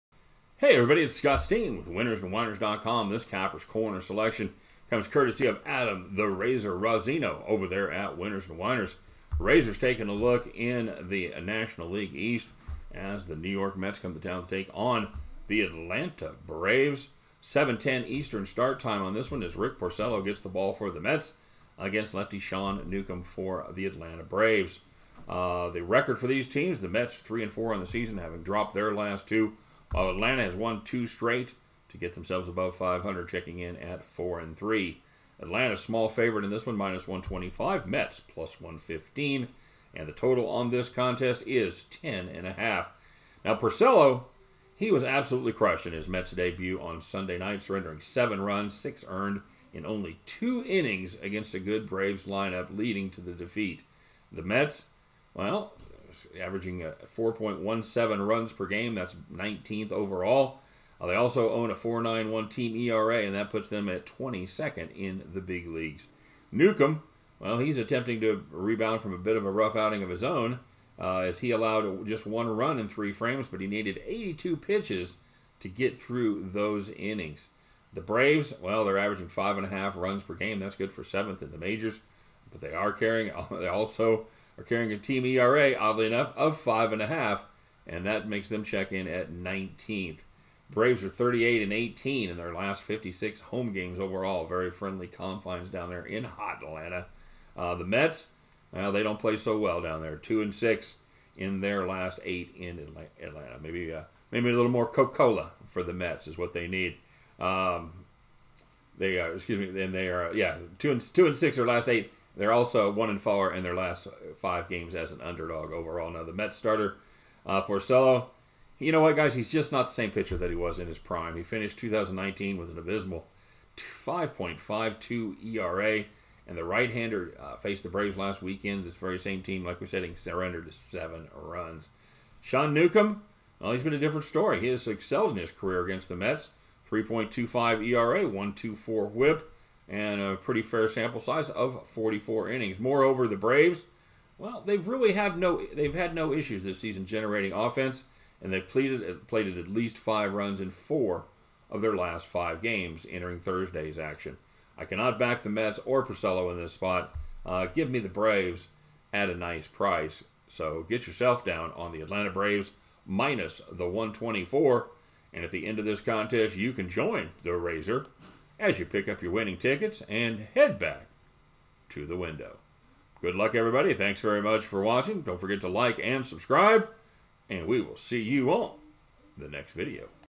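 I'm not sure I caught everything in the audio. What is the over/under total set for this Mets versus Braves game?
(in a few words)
10.5.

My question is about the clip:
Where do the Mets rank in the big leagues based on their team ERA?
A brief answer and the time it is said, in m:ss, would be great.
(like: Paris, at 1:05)
22nd, at 1:04.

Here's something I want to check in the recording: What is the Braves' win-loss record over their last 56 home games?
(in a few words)
38 and 18.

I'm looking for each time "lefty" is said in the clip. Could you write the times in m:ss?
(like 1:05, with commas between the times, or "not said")
0:22.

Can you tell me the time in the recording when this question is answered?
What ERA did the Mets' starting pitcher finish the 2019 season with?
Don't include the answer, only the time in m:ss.
2:03.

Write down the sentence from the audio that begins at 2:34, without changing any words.
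I cannot back the Mets or Porcello in this spot.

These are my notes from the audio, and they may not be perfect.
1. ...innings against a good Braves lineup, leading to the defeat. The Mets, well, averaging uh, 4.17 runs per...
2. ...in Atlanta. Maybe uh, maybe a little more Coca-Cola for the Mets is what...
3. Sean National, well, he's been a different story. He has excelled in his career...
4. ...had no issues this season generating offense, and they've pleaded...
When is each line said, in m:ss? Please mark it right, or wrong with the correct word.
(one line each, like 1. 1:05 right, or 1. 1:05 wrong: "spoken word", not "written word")
1. 0:50 right
2. 1:42 right
3. 2:12 wrong: "Newcomb", not "National"
4. 2:25 right.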